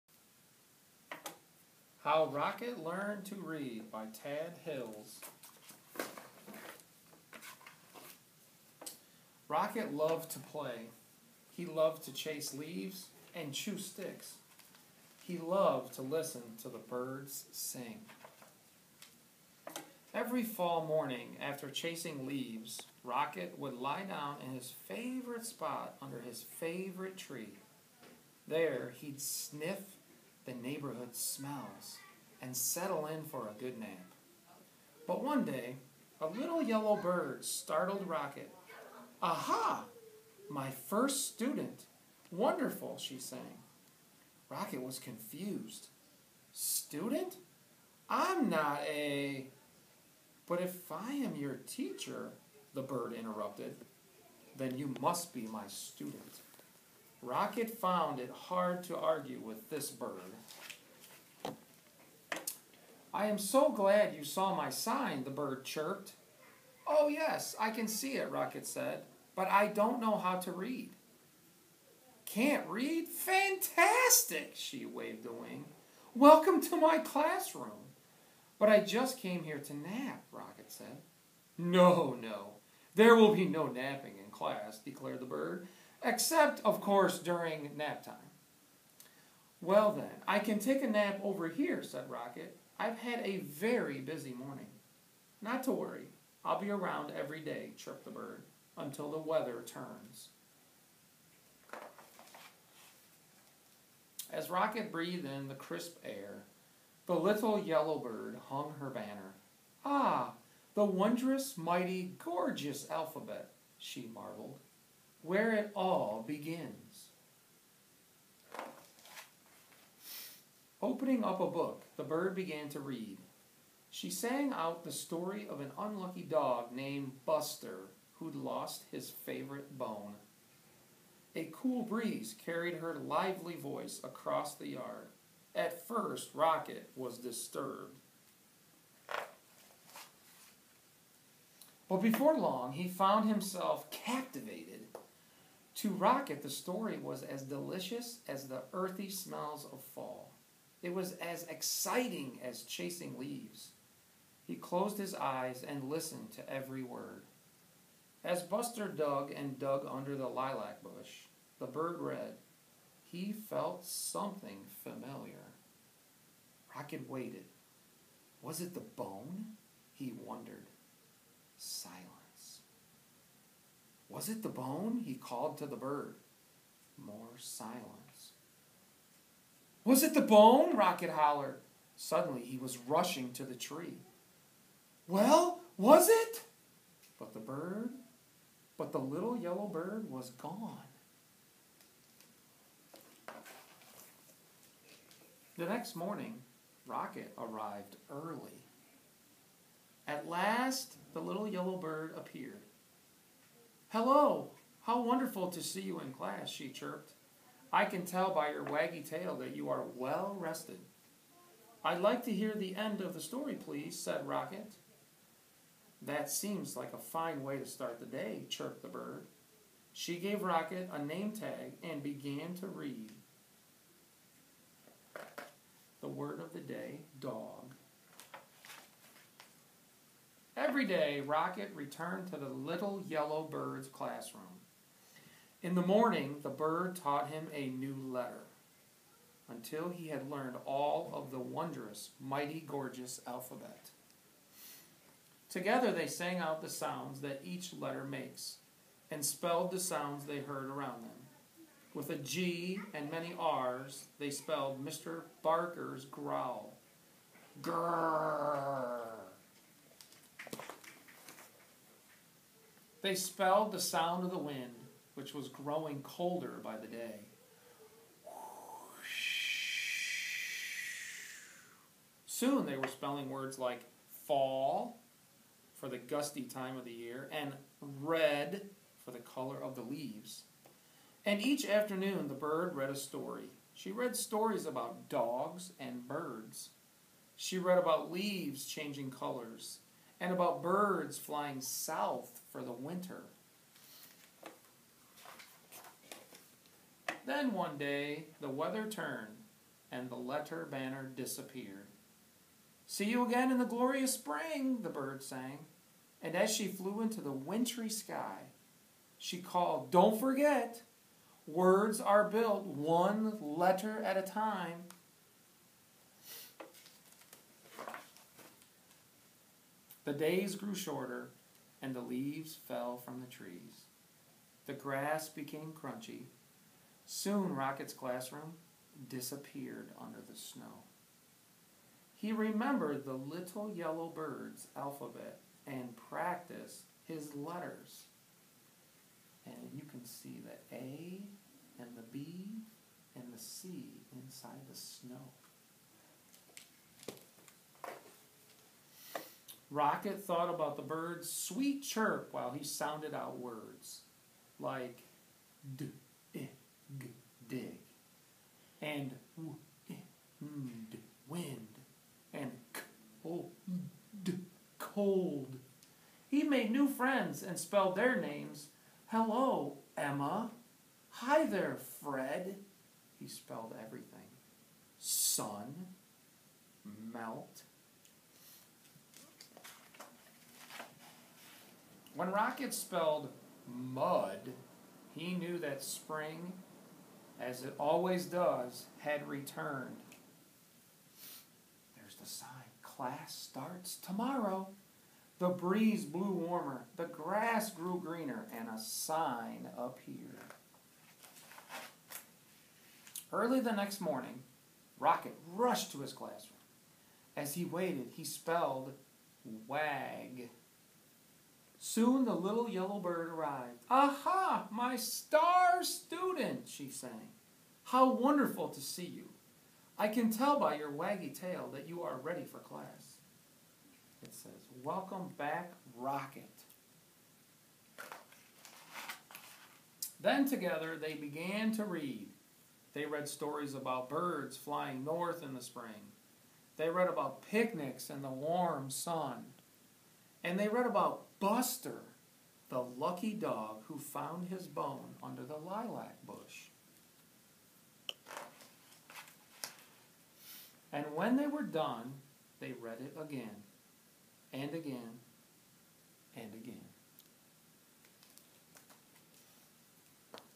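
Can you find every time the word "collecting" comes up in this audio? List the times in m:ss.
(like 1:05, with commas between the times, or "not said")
not said.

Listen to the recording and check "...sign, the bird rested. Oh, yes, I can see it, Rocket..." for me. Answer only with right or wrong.
wrong.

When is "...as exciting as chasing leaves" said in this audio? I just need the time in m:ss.
2:31.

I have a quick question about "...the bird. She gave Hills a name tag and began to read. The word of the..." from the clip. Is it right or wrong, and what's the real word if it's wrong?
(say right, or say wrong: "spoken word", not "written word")
wrong: "Rocket", not "Hills".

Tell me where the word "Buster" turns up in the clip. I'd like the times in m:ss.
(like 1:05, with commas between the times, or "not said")
2:07, 2:38, 7:21.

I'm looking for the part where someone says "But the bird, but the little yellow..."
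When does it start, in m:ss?
3:07.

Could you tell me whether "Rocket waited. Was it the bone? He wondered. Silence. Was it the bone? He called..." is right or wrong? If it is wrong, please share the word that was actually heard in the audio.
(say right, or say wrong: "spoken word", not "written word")
right.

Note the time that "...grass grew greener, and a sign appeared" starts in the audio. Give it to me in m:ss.
6:37.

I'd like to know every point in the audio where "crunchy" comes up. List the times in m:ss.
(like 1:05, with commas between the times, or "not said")
5:25.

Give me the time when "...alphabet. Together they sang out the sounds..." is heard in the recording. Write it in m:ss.
4:03.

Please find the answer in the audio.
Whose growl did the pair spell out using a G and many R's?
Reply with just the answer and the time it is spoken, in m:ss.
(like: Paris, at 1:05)
Mr. Barker, at 4:14.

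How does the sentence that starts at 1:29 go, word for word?
Well, then, I can take a nap over here, said Rocket.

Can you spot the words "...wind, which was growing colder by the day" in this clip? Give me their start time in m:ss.
4:24.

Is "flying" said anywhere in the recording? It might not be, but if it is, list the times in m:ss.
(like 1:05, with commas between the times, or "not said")
4:51, 7:14.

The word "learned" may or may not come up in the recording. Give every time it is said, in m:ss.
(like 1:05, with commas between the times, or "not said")
0:02, 4:00.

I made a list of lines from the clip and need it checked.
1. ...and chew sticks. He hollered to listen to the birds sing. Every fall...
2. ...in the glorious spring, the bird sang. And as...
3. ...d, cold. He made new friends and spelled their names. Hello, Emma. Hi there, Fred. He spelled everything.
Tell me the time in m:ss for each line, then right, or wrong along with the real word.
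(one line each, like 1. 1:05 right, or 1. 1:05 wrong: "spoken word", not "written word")
1. 0:13 wrong: "loved", not "hollered"
2. 5:03 right
3. 6:04 right.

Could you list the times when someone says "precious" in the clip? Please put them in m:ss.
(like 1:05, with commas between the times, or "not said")
not said.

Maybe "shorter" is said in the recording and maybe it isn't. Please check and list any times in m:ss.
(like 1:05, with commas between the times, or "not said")
5:20.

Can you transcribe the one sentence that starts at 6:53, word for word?
Aha, my star student, she sang.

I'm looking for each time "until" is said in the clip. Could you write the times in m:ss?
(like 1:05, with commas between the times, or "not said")
1:38, 3:59.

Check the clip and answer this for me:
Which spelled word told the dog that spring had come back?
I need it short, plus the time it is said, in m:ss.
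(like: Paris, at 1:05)
mud, at 6:23.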